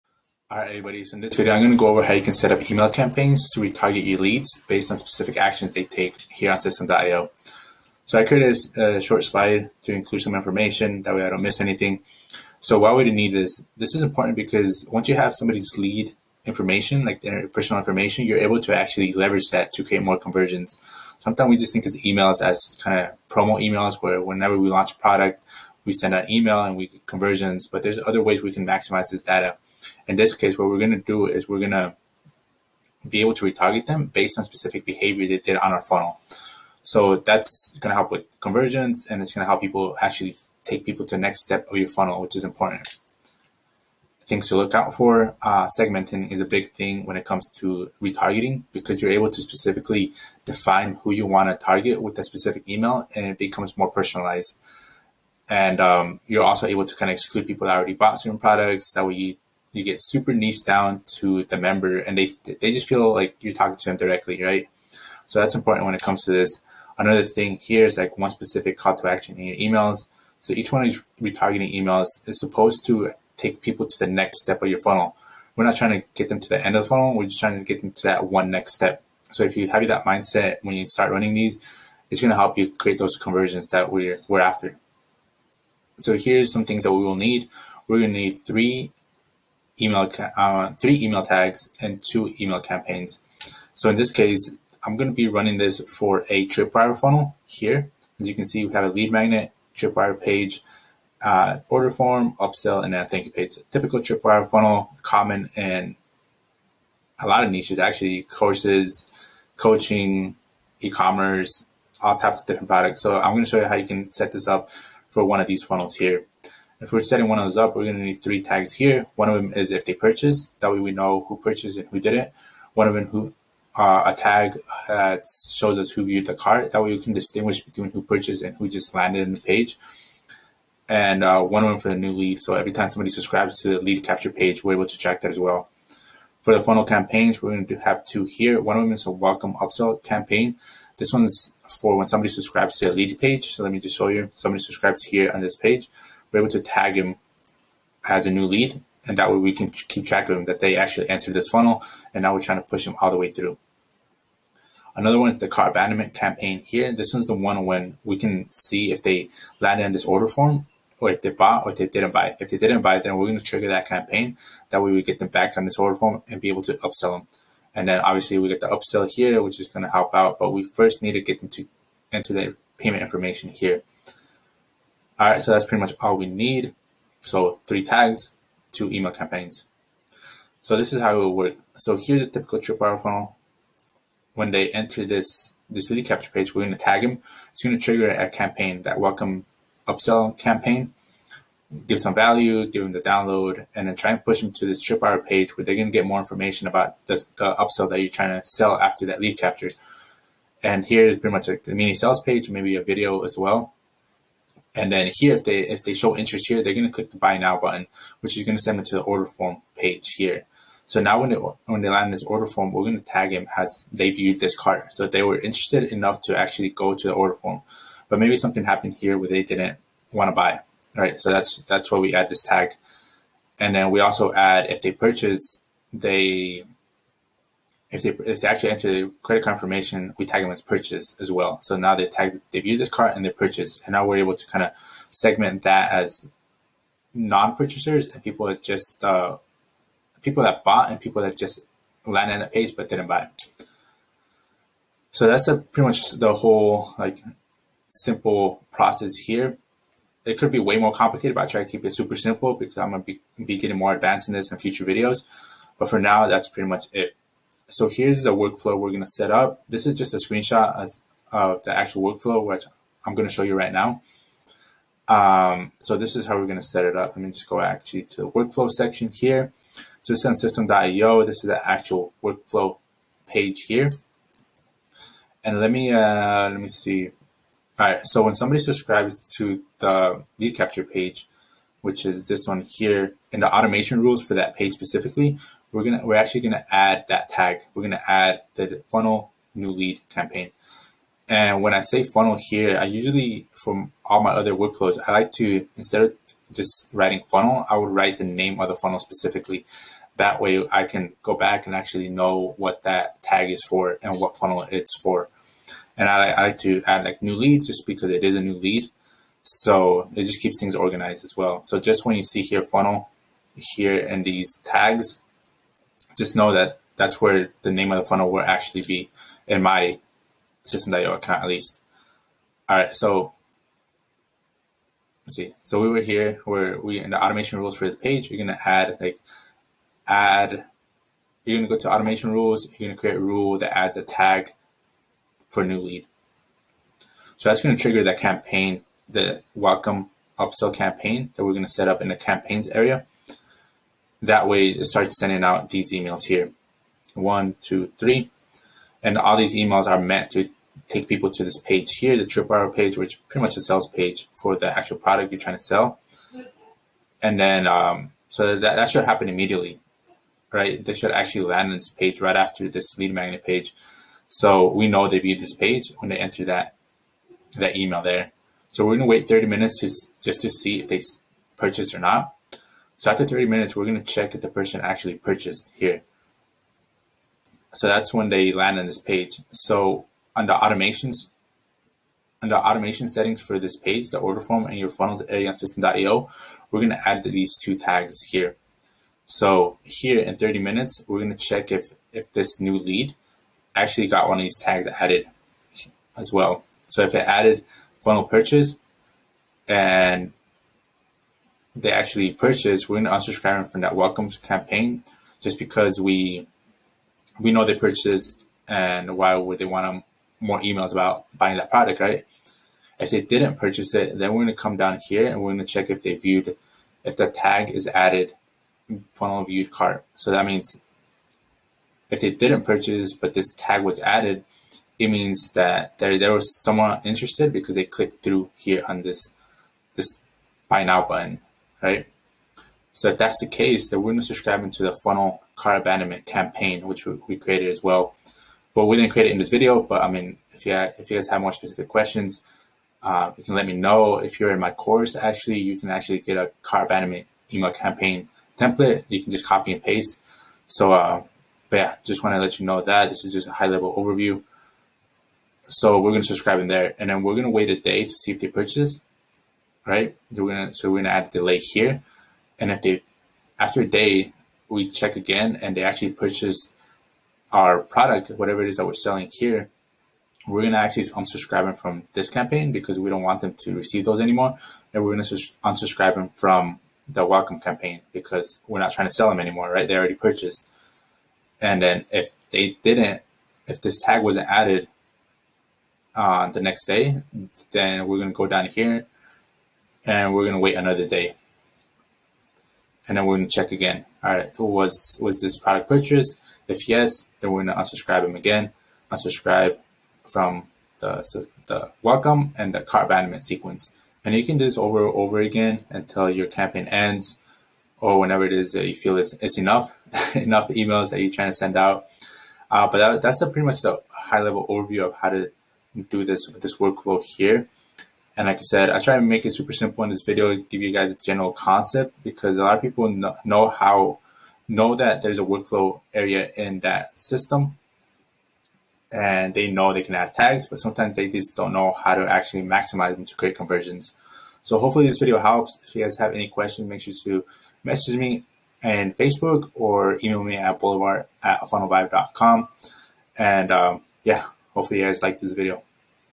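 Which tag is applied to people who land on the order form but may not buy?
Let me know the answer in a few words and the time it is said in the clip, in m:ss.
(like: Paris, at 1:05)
viewed cart, at 3:34.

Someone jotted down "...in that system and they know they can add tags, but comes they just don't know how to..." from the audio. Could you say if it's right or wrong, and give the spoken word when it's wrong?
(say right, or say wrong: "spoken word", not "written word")
wrong: "sometimes", not "comes".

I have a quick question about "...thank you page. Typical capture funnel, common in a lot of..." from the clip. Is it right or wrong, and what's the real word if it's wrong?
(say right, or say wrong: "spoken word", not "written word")
wrong: "tripwire", not "capture".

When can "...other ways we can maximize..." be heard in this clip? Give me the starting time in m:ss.
0:28.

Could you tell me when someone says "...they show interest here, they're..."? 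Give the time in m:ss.
3:25.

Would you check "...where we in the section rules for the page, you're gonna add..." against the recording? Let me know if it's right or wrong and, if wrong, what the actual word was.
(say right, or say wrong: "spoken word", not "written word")
wrong: "automation", not "section".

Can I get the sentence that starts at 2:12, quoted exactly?
So every time somebody subscribes to the lead capture page, we're able to track that as well.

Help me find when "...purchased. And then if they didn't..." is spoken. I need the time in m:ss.
8:00.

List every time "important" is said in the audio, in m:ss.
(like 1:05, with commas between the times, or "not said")
0:14, 0:42, 1:05.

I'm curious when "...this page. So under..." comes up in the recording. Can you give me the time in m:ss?
6:18.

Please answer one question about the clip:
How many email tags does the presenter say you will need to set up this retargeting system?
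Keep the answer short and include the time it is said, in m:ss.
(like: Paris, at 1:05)
3, at 1:30.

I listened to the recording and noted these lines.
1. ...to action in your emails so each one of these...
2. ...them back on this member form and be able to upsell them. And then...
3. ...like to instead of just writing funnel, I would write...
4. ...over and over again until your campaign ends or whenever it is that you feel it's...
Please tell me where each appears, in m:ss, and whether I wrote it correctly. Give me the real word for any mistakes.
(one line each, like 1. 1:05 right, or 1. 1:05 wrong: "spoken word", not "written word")
1. 1:08 right
2. 2:45 wrong: "order", not "member"
3. 4:55 right
4. 8:24 right.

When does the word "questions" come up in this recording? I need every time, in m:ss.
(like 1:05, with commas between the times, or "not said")
7:21, 8:56.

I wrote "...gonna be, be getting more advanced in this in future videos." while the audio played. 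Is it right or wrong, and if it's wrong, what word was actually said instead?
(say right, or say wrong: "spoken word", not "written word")
right.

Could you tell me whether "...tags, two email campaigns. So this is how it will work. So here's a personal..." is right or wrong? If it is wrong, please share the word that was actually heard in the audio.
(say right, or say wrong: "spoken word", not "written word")
wrong: "typical", not "personal".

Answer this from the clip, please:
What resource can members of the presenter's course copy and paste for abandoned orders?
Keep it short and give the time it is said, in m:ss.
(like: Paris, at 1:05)
email campaign template, at 7:26.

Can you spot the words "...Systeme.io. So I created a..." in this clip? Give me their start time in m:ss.
0:06.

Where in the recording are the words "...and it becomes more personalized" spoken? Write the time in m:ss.
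0:53.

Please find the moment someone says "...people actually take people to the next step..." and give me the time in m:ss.
0:39.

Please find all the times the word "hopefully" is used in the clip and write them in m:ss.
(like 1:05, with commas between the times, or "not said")
8:54, 9:04.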